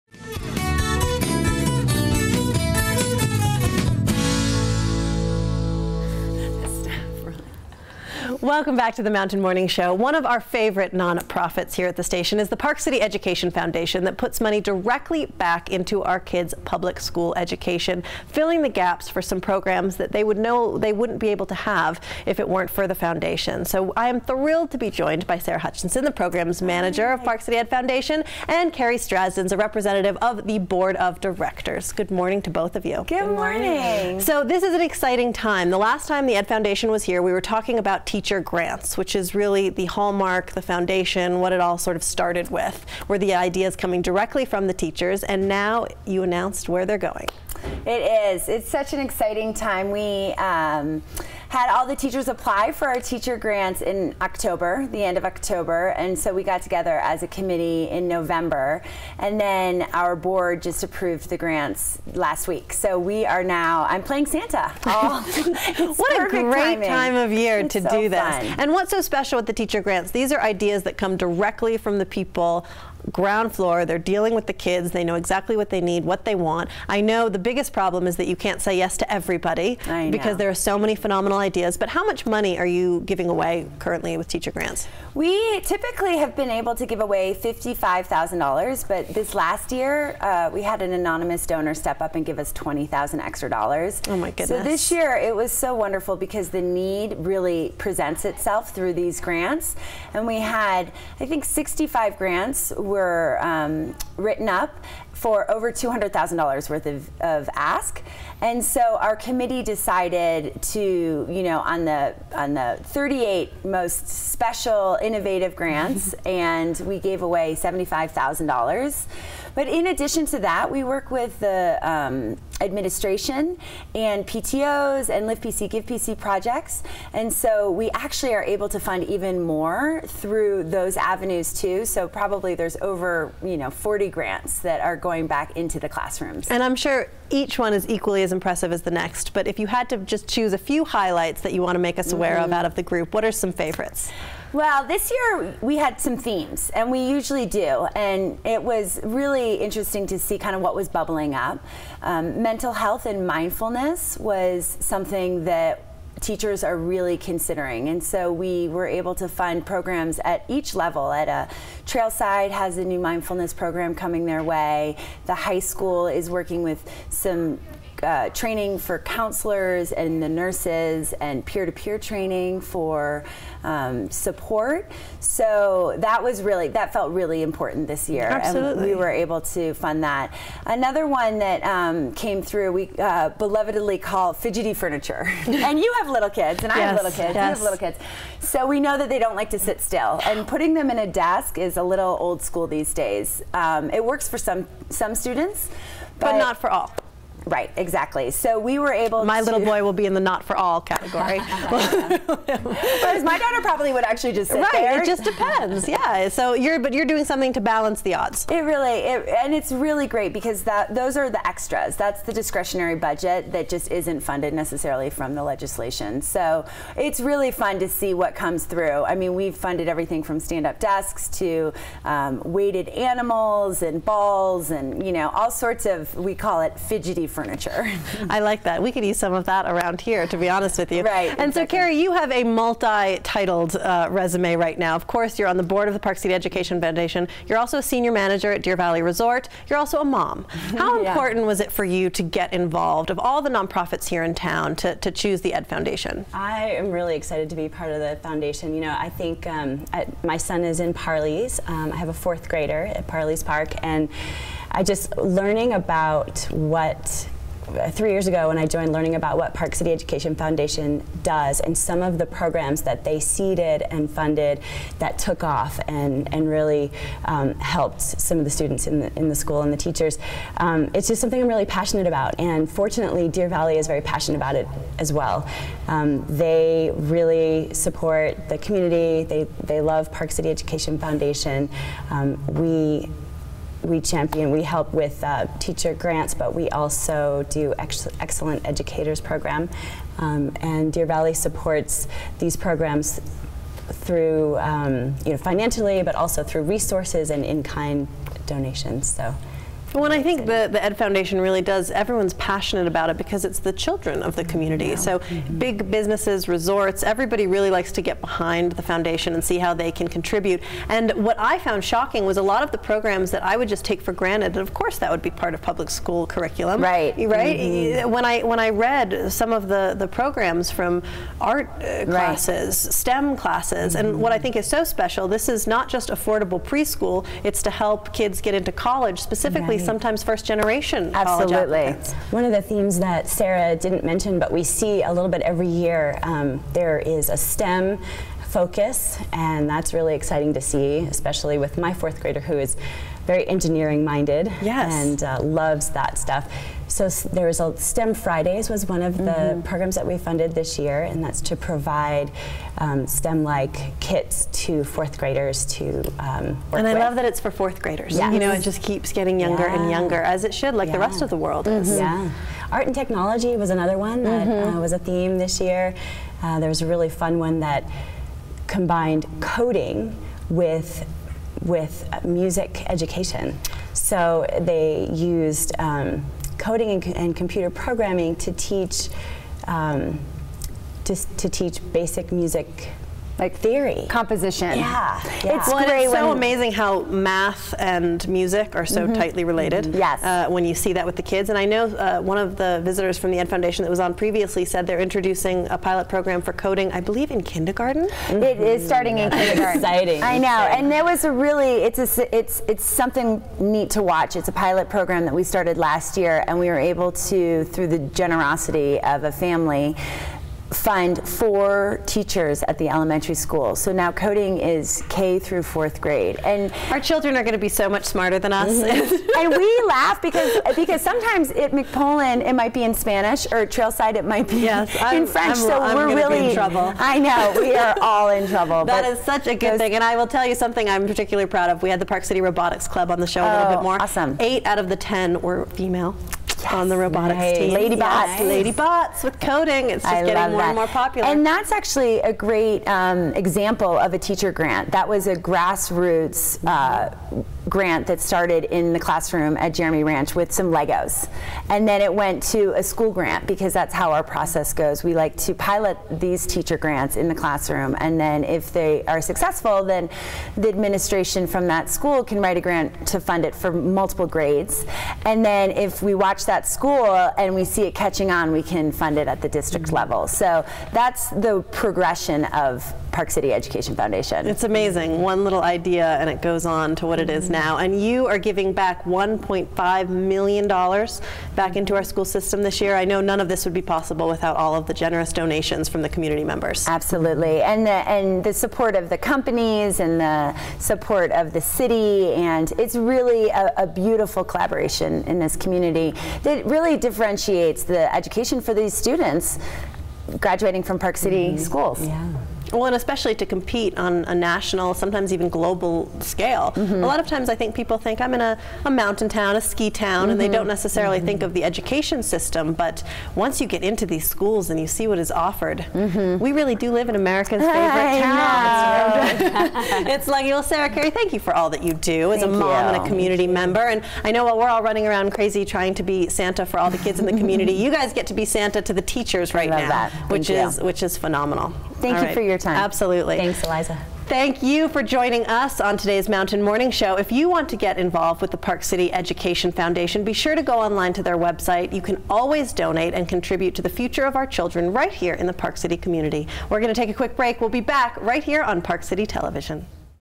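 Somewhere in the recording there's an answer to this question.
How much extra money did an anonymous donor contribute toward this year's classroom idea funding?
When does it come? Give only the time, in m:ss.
1:32.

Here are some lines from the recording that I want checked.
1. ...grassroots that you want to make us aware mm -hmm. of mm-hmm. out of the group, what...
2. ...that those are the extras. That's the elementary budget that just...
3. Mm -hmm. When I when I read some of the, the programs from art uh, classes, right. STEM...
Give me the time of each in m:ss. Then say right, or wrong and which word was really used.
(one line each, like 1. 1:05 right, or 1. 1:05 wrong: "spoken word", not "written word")
1. 2:20 wrong: "highlights", not "grassroots"
2. 3:30 wrong: "discretionary", not "elementary"
3. 5:17 right.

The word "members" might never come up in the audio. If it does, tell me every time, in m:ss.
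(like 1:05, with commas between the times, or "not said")
8:06, 8:43.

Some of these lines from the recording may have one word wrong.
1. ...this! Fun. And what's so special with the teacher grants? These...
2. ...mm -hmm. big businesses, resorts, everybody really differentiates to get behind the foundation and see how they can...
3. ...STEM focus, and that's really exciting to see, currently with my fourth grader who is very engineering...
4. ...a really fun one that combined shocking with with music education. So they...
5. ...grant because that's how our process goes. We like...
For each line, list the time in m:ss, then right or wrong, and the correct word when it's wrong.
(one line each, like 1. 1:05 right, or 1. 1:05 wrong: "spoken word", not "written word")
1. 1:08 right
2. 5:05 wrong: "likes", not "differentiates"
3. 5:37 wrong: "especially", not "currently"
4. 6:06 wrong: "coding", not "shocking"
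5. 7:33 right.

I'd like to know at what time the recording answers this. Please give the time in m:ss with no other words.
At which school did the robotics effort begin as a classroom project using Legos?
7:29.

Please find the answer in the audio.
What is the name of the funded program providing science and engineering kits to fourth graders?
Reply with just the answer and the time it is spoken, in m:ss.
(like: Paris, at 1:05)
STEM Fridays, at 5:47.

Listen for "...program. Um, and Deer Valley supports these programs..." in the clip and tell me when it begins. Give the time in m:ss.
4:49.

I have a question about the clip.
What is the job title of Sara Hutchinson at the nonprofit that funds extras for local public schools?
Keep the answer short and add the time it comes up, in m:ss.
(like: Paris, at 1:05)
Programs manager, at 0:26.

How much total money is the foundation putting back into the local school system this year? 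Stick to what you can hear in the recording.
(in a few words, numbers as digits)
$1.5 million.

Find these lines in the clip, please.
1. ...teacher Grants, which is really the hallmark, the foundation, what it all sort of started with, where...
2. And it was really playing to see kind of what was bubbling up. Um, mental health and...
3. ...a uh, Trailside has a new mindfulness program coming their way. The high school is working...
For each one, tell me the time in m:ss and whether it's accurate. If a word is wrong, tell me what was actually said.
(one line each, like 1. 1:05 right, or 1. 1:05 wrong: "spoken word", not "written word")
1. 0:38 right
2. 2:27 wrong: "interesting", not "playing"
3. 2:41 right.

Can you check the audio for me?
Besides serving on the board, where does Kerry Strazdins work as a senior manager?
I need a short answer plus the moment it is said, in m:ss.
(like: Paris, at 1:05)
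Deer Valley Resort, at 3:58.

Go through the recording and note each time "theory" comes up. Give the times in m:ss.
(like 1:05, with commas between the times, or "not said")
6:23.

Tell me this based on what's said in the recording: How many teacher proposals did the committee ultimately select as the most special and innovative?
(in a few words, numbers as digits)
38.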